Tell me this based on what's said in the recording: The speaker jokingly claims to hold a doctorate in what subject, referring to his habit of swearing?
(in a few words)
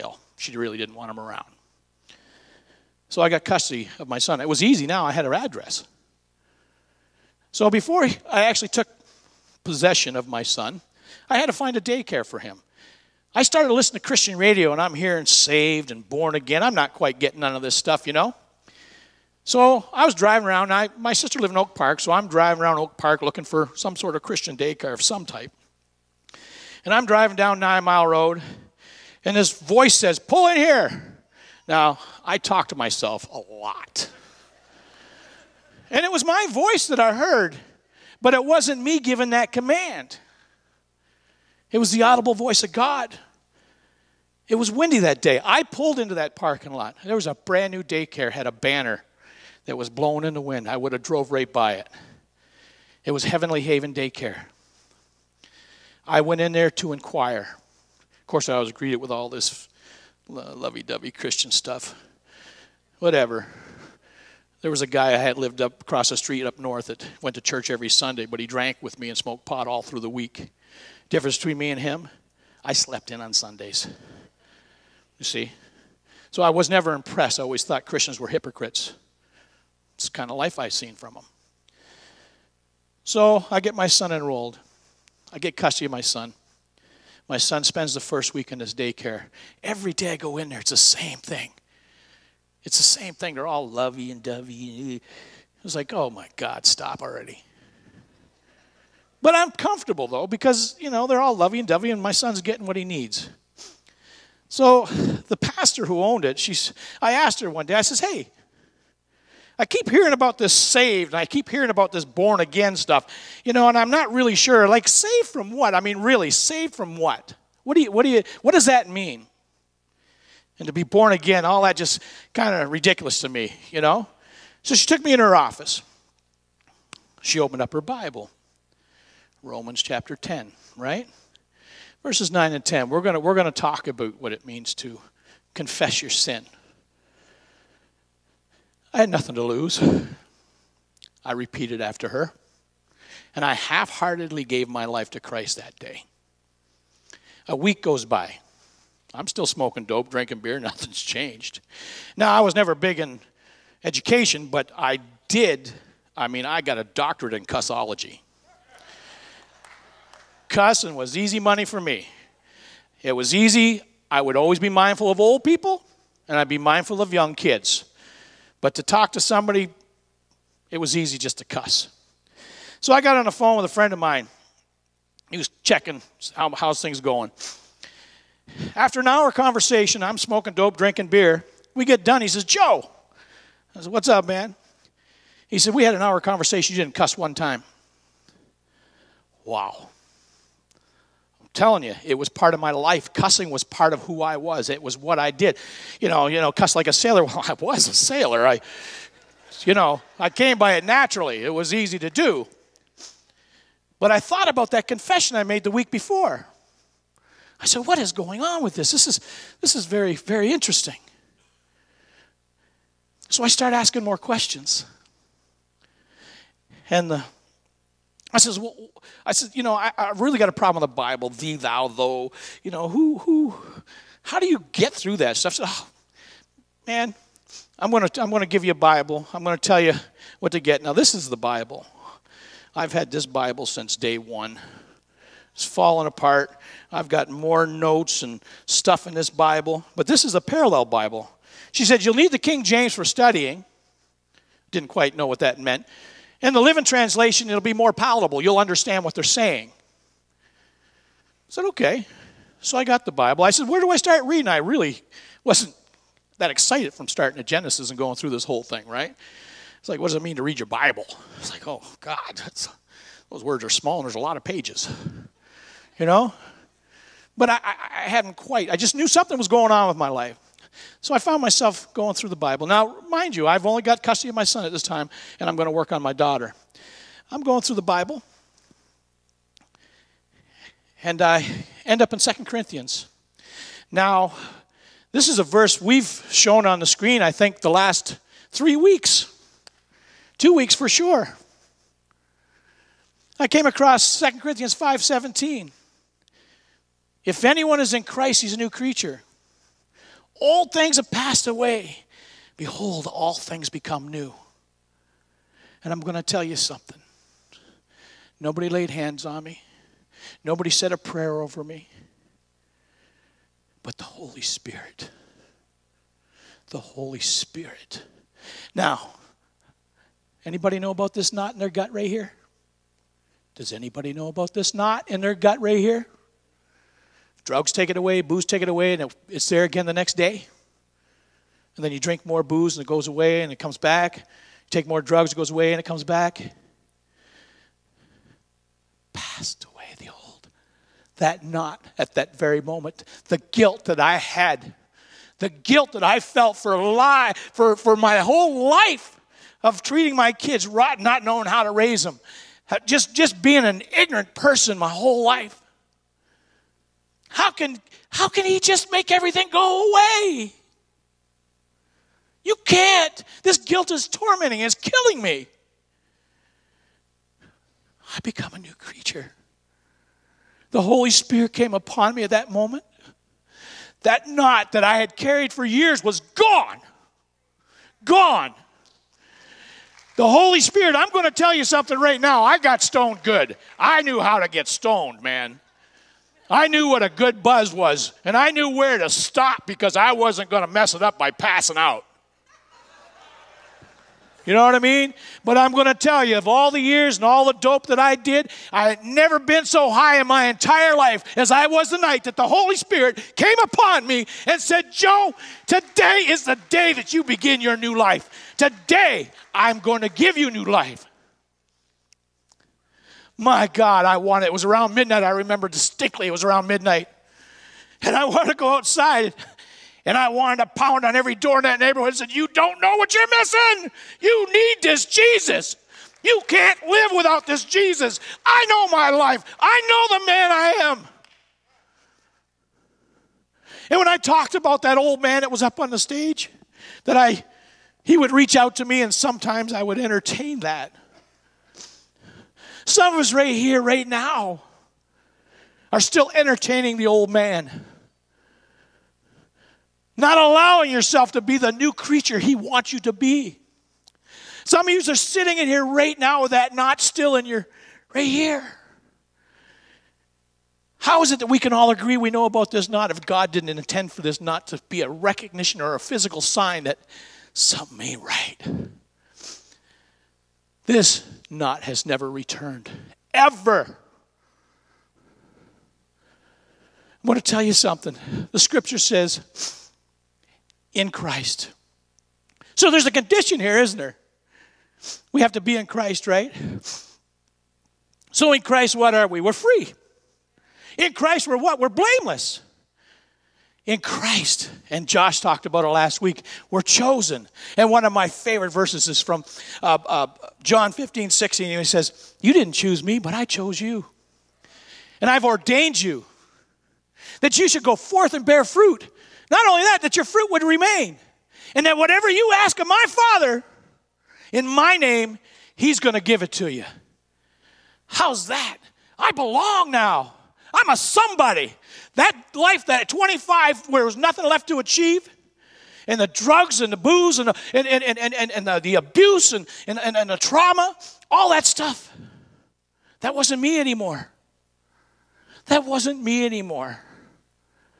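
Cussology.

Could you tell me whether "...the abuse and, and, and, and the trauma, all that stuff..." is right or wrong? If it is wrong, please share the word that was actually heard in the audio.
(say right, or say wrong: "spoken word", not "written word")
right.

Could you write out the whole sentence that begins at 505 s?
And I've ordained you that you should go forth and bear fruit.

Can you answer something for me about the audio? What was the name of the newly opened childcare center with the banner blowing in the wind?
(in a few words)
Heavenly Haven Daycare.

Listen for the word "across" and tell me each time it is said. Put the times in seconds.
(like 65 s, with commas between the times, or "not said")
65 s, 293 s.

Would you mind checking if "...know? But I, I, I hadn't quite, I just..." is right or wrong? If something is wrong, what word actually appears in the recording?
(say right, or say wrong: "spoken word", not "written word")
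right.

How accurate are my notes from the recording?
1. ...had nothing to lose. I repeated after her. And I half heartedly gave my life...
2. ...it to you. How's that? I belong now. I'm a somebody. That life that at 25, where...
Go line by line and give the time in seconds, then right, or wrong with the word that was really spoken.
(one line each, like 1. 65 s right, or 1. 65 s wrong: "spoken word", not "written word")
1. 138 s right
2. 516 s right.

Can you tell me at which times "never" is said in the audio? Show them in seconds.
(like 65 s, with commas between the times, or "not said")
76 s, 152 s, 399 s, 472 s.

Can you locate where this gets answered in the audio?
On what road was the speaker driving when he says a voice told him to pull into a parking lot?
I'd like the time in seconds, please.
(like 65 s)
27 s.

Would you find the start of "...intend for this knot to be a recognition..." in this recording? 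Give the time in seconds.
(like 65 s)
463 s.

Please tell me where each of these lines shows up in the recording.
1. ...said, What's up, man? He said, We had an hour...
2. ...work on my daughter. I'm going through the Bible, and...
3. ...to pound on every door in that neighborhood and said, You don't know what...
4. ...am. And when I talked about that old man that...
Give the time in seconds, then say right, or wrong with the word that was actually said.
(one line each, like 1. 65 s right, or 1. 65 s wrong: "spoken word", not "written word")
1. 183 s right
2. 275 s right
3. 420 s right
4. 430 s right.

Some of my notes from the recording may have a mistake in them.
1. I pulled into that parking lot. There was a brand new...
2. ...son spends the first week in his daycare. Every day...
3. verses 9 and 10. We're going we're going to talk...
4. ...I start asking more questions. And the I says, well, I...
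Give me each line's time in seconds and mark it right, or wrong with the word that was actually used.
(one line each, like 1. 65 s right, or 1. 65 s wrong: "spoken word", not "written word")
1. 45 s right
2. 87 s right
3. 132 s right
4. 213 s right.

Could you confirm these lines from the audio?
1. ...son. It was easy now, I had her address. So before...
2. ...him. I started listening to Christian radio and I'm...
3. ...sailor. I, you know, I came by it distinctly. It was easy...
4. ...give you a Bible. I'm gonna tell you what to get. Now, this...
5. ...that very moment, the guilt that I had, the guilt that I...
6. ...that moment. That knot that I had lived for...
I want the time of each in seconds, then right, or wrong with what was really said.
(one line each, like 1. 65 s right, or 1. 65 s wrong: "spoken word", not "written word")
1. 4 s right
2. 12 s right
3. 197 s wrong: "naturally", not "distinctly"
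4. 228 s right
5. 342 s right
6. 372 s wrong: "carried", not "lived".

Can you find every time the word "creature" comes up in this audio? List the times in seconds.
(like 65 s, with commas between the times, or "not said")
298 s, 368 s, 451 s.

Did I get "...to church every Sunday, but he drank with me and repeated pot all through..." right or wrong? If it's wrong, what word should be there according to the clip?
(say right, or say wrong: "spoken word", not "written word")
wrong: "smoked", not "repeated".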